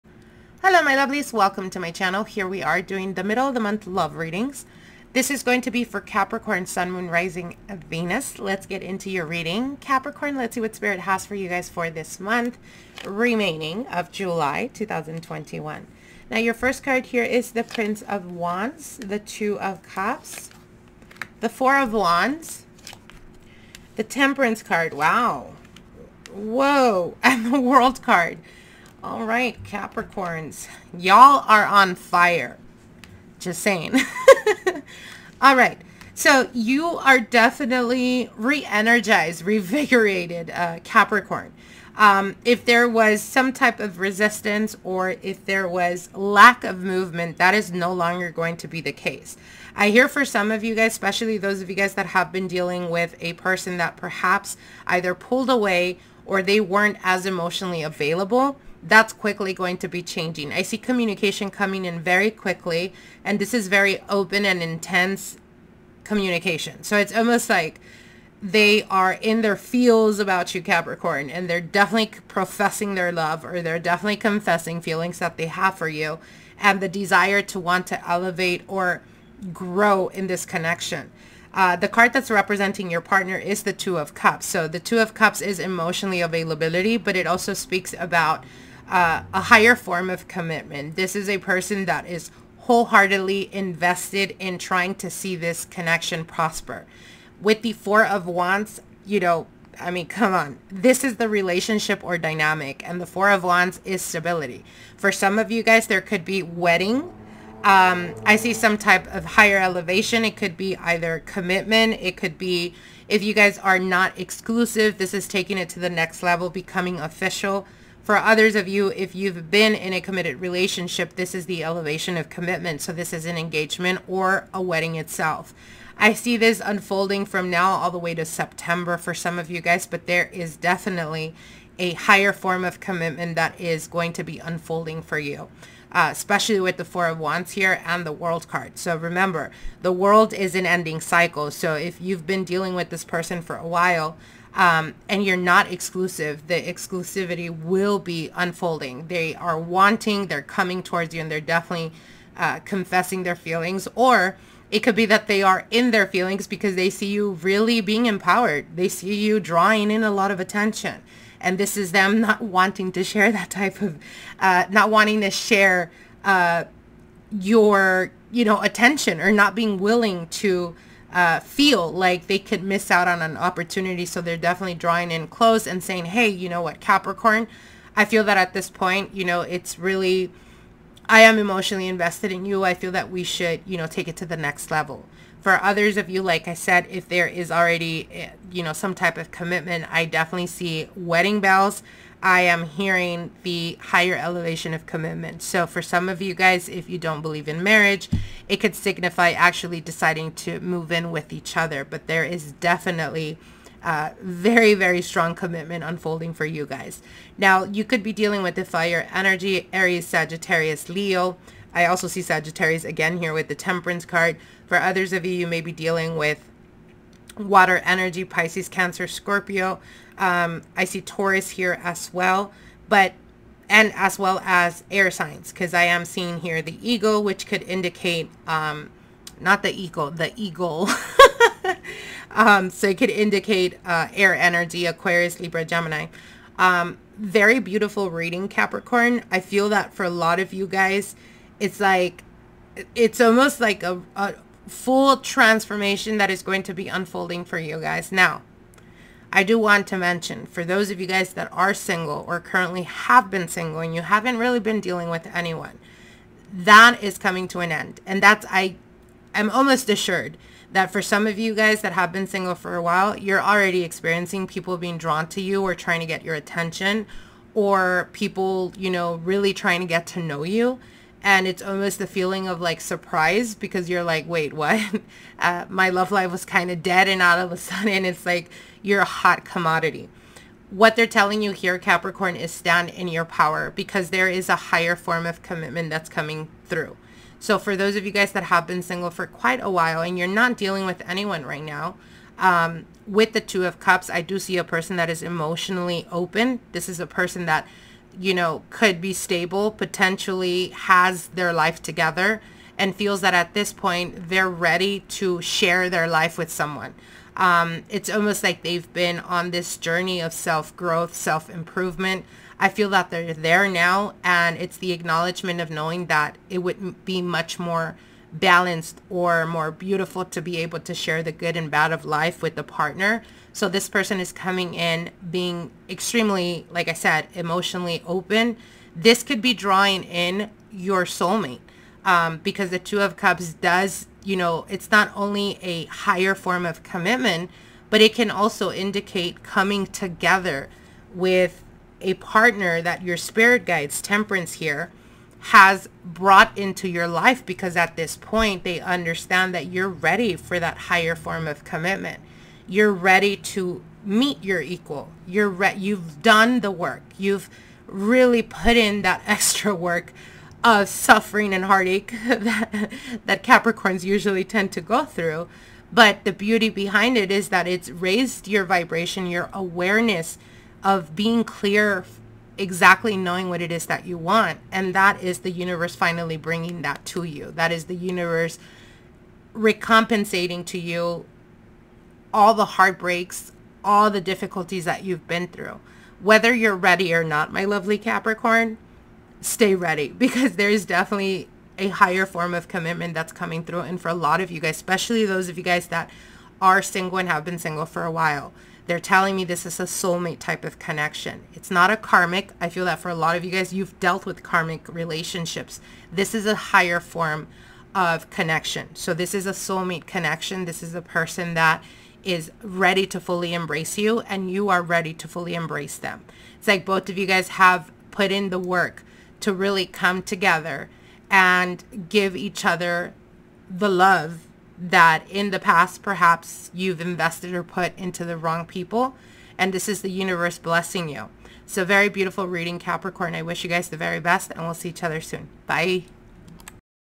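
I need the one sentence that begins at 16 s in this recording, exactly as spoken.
Now your first card here is the Prince of Wands, the Two of Cups, the Four of Wands, the Temperance card.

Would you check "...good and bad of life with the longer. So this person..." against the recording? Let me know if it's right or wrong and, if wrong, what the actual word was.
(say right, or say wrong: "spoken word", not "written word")
wrong: "partner", not "longer".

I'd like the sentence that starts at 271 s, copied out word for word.
And it's almost the feeling of like surprise because you're like, wait, what?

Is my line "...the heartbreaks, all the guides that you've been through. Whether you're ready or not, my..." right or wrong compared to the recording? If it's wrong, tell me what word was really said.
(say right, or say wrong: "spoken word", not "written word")
wrong: "difficulties", not "guides".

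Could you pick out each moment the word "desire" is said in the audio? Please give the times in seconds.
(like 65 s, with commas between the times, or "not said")
76 s.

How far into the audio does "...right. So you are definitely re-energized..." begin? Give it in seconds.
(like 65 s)
35 s.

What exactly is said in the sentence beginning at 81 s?
Uh, the card that's representing your partner is the Two of Cups.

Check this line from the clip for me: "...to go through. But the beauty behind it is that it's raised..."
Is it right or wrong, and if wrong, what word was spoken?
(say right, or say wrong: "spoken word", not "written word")
right.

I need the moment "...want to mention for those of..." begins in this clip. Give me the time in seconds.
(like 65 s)
249 s.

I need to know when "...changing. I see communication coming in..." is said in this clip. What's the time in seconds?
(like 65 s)
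60 s.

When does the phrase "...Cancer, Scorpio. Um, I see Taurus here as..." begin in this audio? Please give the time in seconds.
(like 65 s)
218 s.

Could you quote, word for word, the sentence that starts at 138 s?
So remember, the world is an ending cycle.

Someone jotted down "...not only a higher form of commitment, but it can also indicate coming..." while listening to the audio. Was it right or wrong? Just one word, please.
right.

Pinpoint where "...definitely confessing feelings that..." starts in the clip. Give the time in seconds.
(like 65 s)
73 s.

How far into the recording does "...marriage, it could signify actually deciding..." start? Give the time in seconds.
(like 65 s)
197 s.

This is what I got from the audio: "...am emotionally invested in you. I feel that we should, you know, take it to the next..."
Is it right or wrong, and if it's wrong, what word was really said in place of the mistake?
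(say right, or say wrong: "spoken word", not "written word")
right.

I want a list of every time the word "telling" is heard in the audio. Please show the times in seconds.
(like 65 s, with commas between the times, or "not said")
281 s, 398 s.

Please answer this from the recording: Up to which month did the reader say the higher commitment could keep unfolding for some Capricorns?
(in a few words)
September.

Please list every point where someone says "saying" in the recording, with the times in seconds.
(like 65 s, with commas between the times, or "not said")
33 s, 175 s.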